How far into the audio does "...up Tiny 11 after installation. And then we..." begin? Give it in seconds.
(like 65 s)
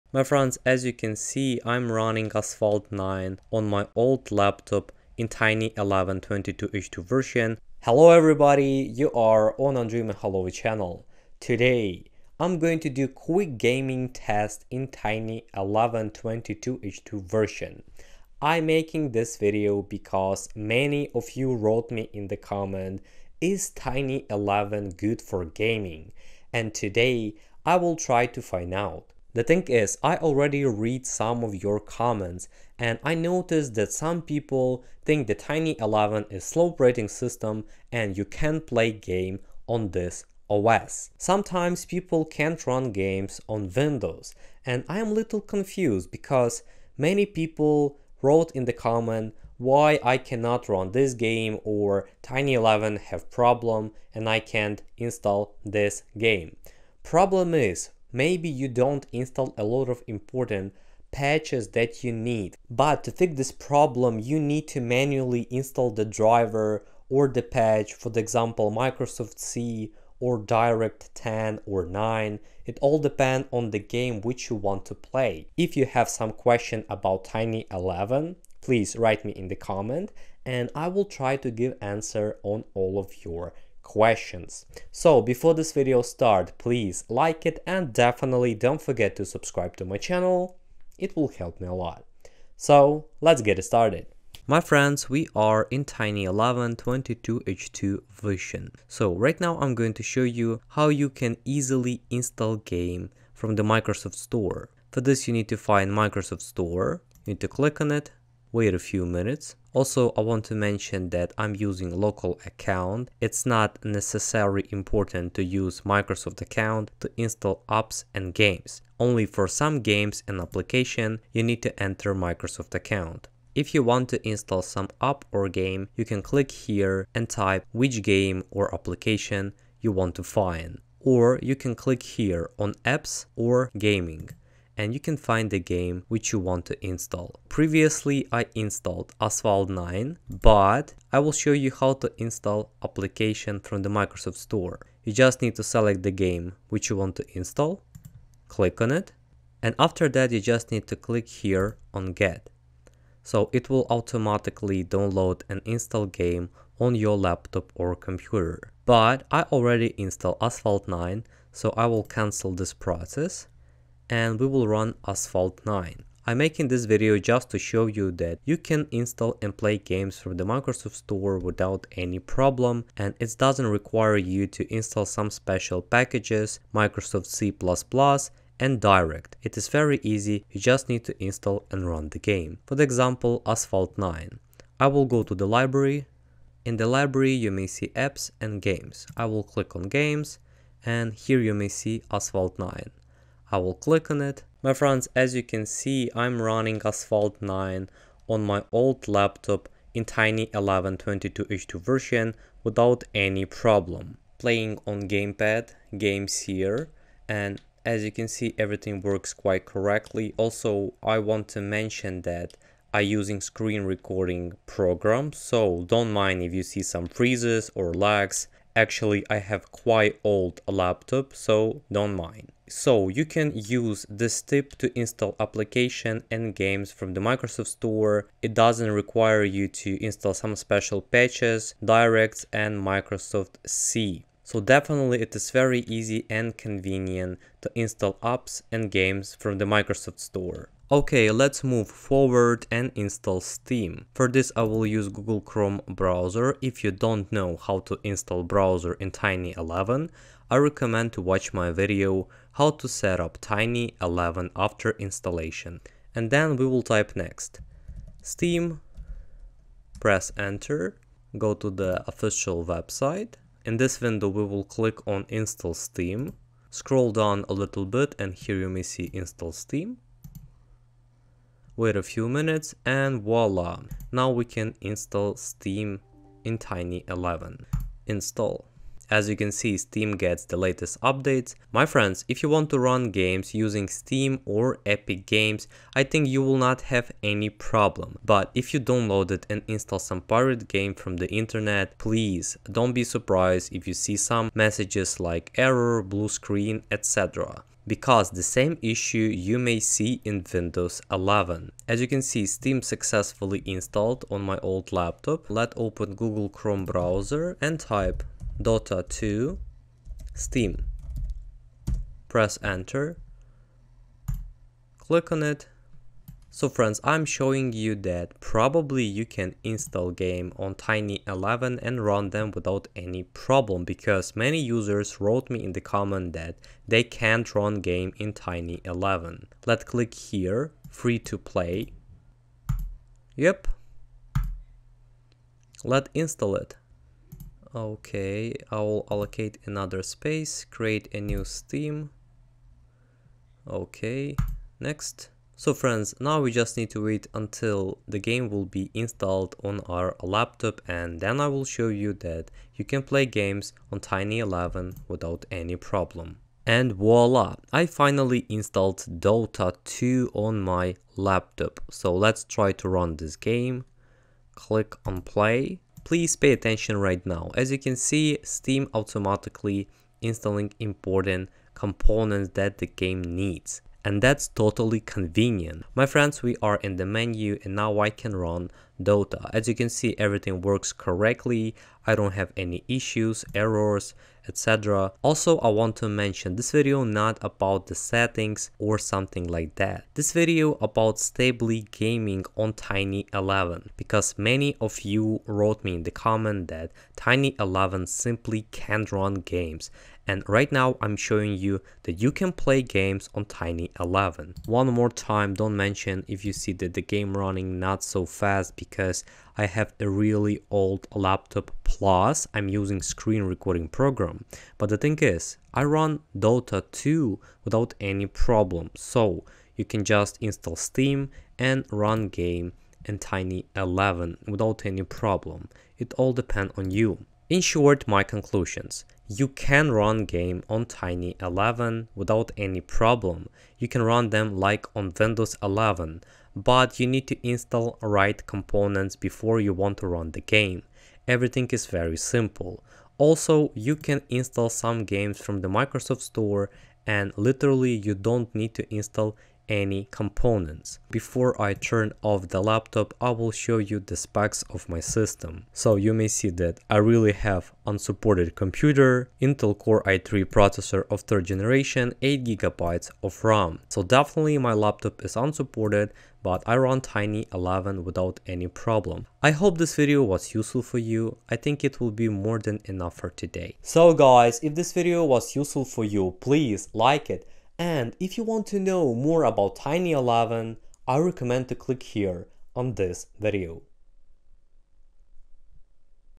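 253 s.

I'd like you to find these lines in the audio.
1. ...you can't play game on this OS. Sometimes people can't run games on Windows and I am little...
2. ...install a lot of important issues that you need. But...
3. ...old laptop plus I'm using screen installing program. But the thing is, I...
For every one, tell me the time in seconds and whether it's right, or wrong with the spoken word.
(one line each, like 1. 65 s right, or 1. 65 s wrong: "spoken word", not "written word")
1. 38 s right
2. 59 s wrong: "patches", not "issues"
3. 410 s wrong: "recording", not "installing".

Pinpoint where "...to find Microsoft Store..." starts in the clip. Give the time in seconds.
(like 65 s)
105 s.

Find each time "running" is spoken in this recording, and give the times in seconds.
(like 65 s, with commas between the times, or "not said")
1 s, 196 s, 407 s.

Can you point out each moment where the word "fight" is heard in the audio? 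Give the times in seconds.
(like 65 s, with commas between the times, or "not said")
not said.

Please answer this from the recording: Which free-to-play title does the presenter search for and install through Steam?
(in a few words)
Dota 2.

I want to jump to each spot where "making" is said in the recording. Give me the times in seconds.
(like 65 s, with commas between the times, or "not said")
18 s, 166 s.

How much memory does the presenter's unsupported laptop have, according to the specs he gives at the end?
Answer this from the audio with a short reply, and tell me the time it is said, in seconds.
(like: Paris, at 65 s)
8GB, at 462 s.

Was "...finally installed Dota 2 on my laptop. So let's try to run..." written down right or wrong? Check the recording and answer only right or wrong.
right.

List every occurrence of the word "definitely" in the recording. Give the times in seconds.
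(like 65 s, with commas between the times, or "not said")
87 s, 234 s, 464 s.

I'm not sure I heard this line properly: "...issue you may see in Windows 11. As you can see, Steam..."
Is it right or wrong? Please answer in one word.
right.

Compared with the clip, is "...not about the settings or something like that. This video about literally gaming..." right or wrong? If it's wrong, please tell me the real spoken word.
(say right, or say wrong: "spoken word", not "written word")
wrong: "stably", not "literally".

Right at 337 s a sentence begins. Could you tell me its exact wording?
Okay, I will allocate another space, create a new Steam.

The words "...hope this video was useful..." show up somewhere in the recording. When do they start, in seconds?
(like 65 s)
469 s.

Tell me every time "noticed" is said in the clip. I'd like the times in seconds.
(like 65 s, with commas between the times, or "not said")
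33 s.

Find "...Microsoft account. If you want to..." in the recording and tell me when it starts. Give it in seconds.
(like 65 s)
122 s.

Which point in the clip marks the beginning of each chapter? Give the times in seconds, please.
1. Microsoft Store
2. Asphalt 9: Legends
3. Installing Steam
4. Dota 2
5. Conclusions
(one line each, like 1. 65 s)
1. 94 s
2. 194 s
3. 240 s
4. 356 s
5. 427 s.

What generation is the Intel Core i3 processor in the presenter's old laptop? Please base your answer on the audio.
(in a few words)
third generation.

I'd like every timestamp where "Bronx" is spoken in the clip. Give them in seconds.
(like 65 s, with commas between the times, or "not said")
not said.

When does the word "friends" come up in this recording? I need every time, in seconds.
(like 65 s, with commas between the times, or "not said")
0 s, 94 s, 194 s, 281 s, 316 s, 345 s, 376 s.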